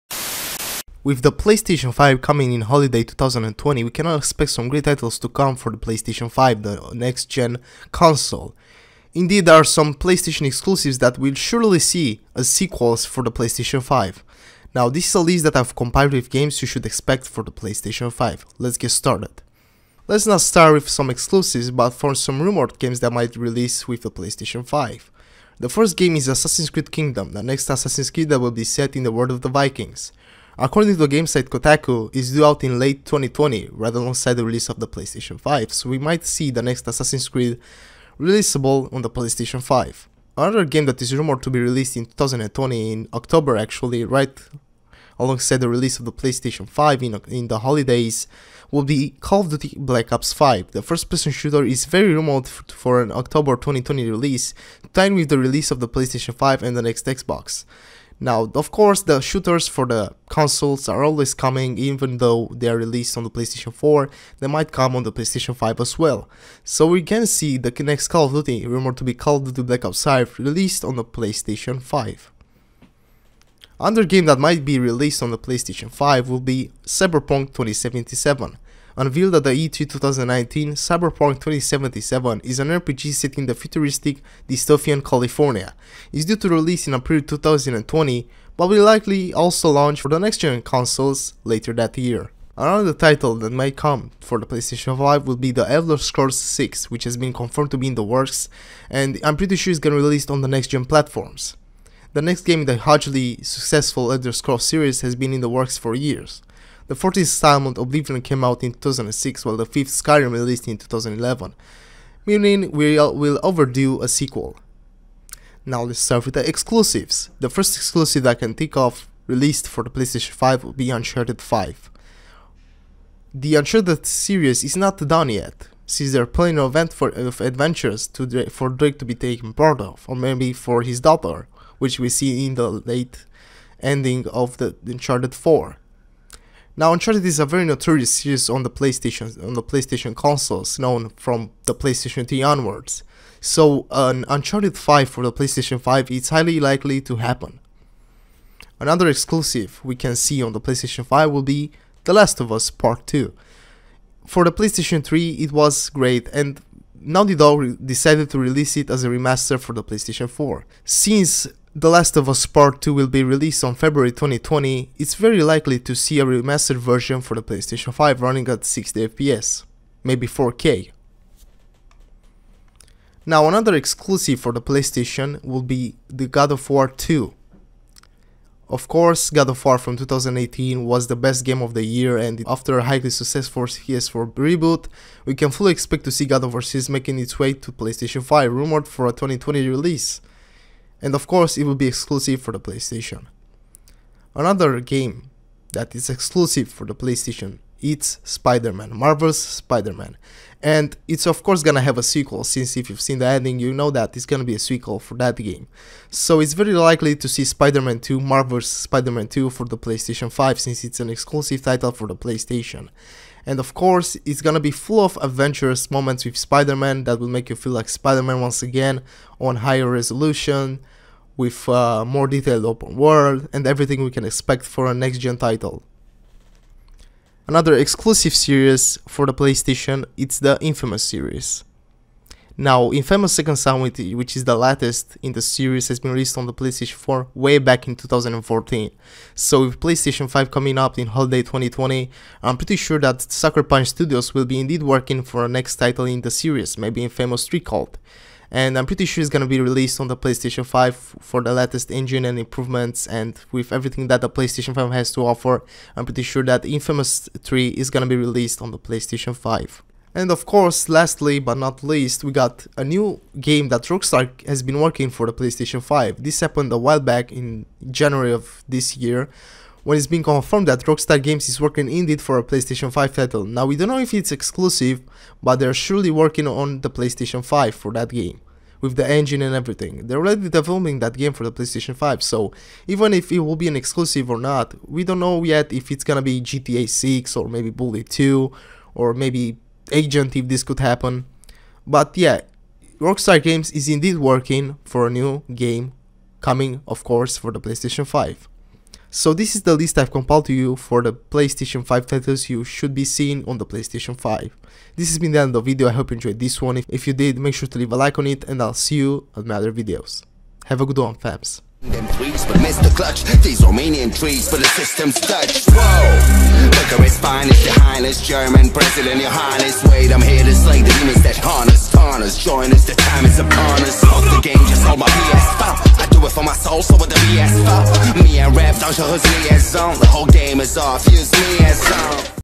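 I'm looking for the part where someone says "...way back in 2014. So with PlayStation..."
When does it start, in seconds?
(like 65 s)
237 s.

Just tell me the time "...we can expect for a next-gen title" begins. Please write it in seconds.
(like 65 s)
224 s.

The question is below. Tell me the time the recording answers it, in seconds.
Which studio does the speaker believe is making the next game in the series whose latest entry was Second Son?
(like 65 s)
243 s.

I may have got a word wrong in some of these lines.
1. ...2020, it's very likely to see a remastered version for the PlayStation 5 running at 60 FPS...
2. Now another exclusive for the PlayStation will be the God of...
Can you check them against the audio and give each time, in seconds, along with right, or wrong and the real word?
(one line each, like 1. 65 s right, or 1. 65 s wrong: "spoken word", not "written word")
1. 164 s right
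2. 173 s right.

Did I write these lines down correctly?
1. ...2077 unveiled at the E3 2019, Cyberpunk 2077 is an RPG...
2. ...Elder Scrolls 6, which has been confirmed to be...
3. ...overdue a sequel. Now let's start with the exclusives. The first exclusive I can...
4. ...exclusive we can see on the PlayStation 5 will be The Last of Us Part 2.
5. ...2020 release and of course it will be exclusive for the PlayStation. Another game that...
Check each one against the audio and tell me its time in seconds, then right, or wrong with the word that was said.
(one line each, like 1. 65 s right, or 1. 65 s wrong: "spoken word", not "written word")
1. 77 s right
2. 95 s right
3. 113 s right
4. 149 s right
5. 189 s right.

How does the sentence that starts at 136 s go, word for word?
Now Uncharted is a very notorious series on the PlayStation on the PlayStation consoles, known from the PlayStation 3 onwards.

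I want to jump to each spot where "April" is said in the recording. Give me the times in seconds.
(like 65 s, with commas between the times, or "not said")
86 s.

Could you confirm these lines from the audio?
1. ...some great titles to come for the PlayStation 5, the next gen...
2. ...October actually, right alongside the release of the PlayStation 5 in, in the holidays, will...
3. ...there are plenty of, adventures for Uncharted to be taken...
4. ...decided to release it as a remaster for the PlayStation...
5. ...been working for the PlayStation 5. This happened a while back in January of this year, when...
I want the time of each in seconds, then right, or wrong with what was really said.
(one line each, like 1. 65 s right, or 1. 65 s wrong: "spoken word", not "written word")
1. 4 s right
2. 43 s right
3. 126 s wrong: "Drake", not "Uncharted"
4. 157 s right
5. 264 s right.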